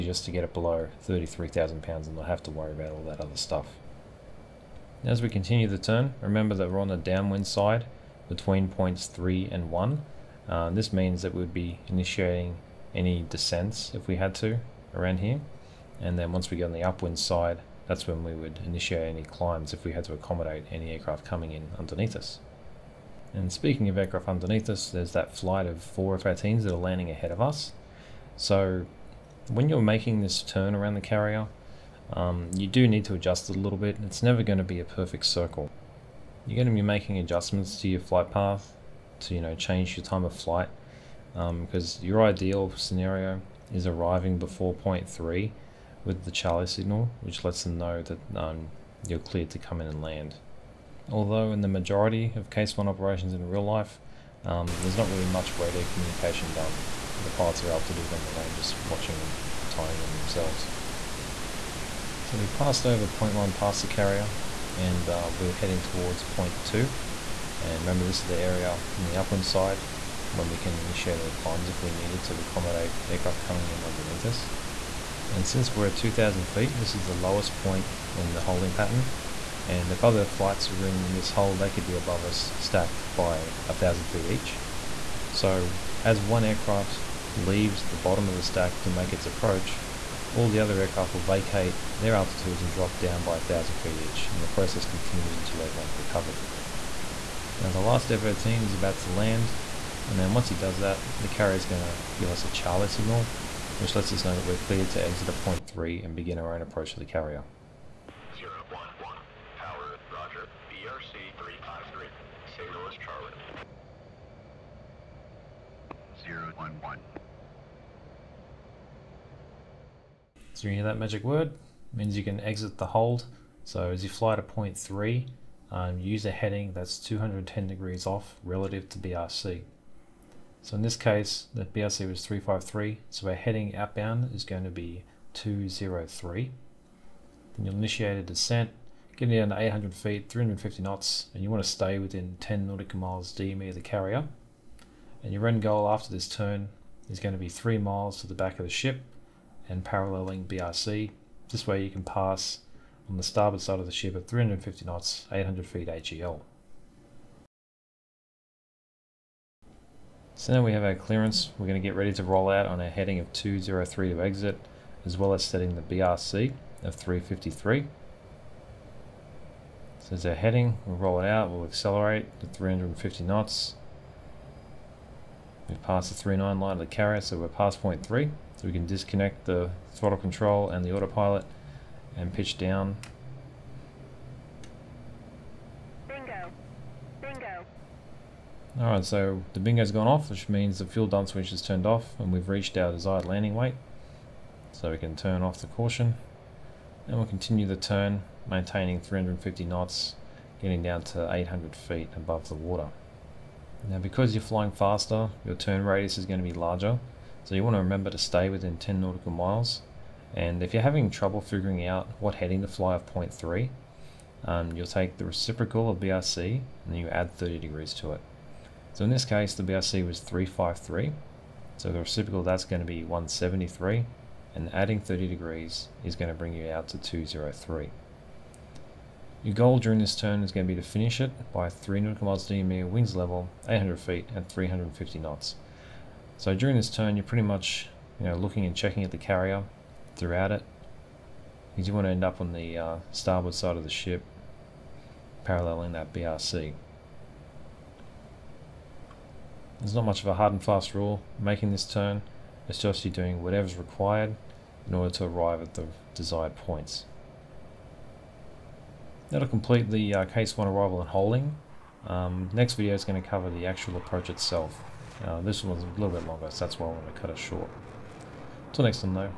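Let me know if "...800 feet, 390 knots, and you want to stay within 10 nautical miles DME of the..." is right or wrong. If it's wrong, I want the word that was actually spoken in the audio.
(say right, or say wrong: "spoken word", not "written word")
wrong: "350", not "390".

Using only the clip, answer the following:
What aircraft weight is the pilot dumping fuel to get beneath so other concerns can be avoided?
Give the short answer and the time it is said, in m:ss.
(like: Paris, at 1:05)
33,000 pounds, at 0:01.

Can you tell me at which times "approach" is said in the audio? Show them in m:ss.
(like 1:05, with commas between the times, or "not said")
1:29, 1:46, 4:23.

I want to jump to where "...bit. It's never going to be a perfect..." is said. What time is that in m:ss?
0:33.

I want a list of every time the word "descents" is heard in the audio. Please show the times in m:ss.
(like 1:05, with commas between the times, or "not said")
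0:13, 2:18.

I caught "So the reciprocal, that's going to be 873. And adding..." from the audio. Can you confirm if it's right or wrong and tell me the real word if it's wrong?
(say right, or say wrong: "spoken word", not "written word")
wrong: "173", not "873".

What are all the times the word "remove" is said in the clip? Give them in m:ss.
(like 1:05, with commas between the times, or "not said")
not said.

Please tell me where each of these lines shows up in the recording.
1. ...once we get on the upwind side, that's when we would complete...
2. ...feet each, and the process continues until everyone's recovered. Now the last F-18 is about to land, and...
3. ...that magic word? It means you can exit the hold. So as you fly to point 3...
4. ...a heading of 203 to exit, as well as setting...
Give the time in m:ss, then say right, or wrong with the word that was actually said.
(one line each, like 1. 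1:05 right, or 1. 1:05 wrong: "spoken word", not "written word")
1. 0:16 wrong: "initiate", not "complete"
2. 1:33 right
3. 2:00 right
4. 2:42 right.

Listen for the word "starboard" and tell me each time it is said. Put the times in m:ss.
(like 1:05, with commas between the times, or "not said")
2:33, 4:03.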